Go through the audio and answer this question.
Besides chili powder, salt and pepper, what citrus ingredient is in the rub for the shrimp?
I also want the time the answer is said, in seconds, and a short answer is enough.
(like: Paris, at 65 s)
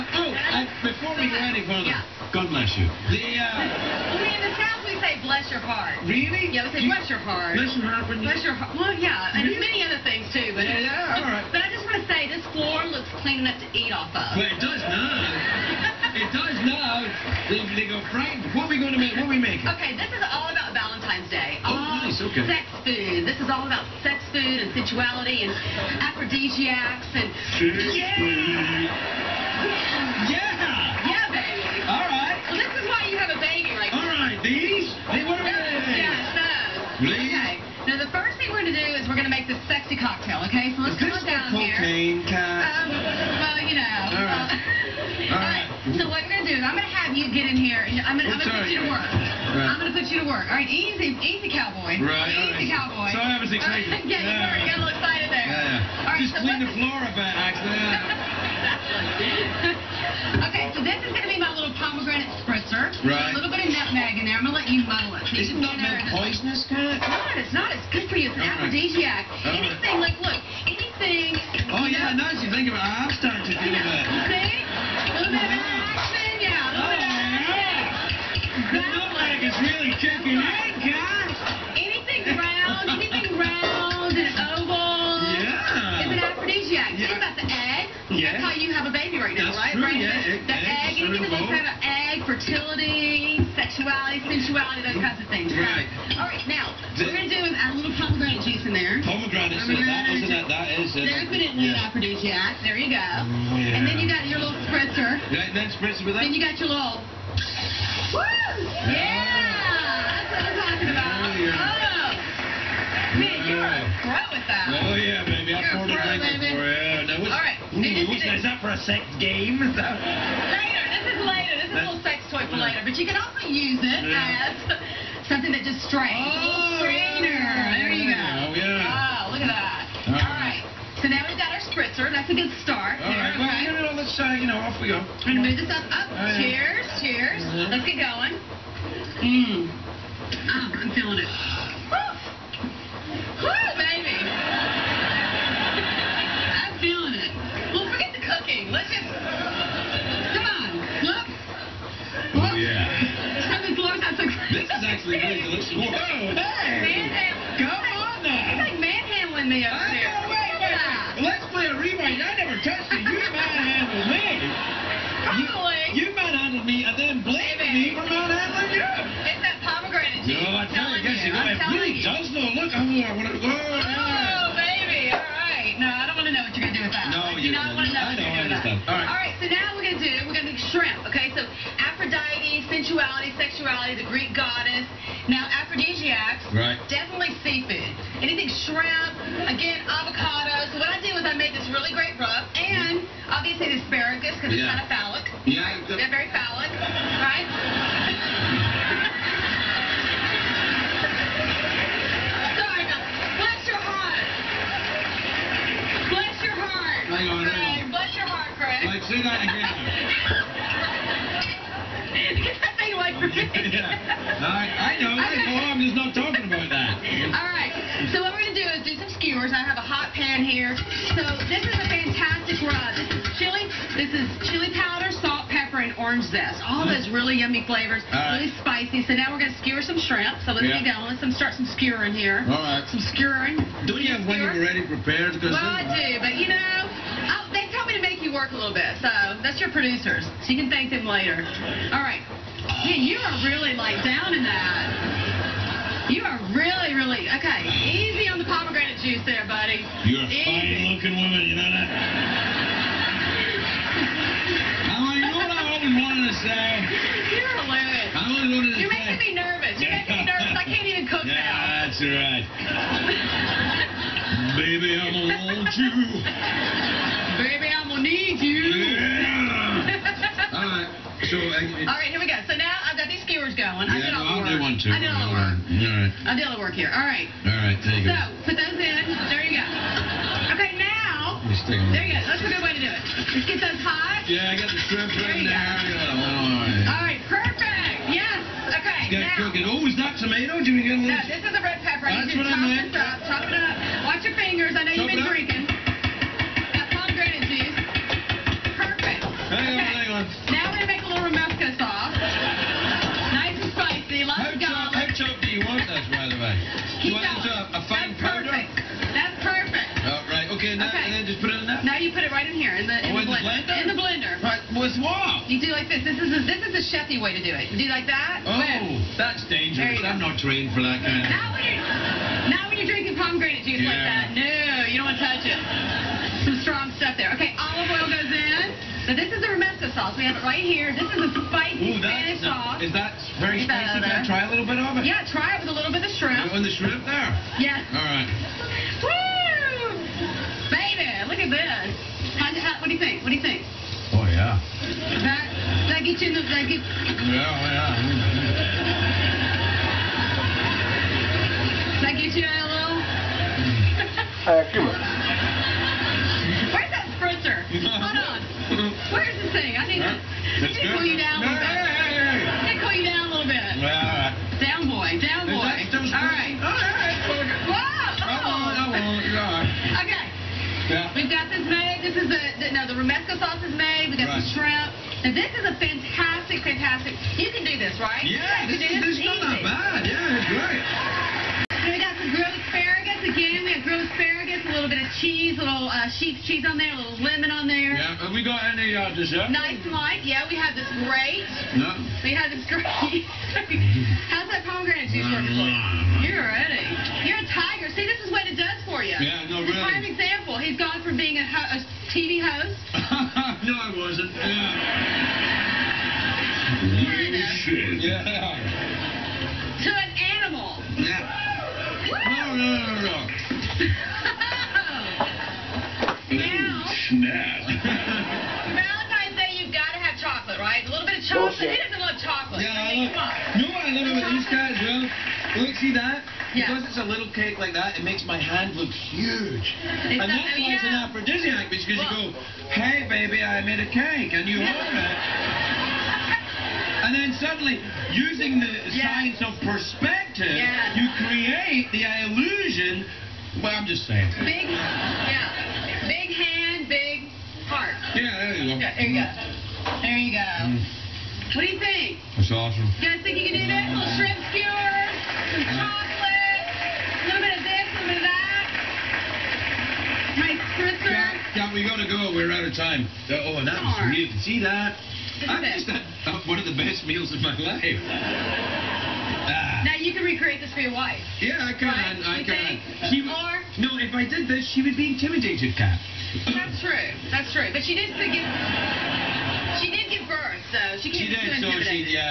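Orange zest, at 226 s.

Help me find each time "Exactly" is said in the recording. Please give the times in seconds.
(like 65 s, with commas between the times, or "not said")
429 s.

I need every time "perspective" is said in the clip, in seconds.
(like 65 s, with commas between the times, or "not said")
439 s.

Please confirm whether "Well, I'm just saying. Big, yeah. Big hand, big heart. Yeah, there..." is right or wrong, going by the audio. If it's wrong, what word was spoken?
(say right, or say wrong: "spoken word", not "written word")
right.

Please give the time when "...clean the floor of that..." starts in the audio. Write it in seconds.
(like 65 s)
56 s.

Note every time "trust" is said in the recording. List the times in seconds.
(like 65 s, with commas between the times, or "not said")
not said.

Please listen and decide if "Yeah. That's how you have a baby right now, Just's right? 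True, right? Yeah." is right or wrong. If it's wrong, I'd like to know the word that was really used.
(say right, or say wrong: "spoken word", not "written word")
wrong: "That", not "Just".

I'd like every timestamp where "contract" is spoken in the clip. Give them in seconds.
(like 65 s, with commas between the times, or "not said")
not said.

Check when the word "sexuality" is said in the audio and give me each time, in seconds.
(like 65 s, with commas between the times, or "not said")
93 s, 183 s.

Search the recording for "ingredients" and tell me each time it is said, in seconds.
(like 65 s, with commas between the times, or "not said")
not said.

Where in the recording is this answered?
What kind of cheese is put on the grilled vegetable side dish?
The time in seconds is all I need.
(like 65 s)
386 s.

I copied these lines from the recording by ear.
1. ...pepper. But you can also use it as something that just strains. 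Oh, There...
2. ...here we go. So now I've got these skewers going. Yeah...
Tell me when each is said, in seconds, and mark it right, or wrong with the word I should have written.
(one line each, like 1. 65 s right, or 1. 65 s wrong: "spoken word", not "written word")
1. 122 s wrong: "later", not "pepper"
2. 272 s right.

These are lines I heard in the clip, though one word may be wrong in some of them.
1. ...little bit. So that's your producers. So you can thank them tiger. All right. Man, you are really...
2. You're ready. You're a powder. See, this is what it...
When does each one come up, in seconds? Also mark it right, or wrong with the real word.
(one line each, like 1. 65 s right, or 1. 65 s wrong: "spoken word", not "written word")
1. 238 s wrong: "later", not "tiger"
2. 396 s wrong: "tiger", not "powder".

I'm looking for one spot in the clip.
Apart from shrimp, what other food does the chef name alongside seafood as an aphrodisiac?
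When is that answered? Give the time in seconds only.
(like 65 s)
189 s.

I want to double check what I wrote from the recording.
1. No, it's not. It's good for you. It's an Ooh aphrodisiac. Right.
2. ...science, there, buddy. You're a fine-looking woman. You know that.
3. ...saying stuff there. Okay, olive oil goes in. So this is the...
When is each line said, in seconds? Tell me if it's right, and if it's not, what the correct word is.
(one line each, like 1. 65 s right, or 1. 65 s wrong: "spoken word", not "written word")
1. 67 s wrong: "All", not "Ooh"
2. 248 s wrong: "juice", not "science"
3. 326 s wrong: "strong", not "saying".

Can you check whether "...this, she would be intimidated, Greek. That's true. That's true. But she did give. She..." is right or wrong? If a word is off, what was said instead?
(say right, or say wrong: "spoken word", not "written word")
wrong: "Cat", not "Greek".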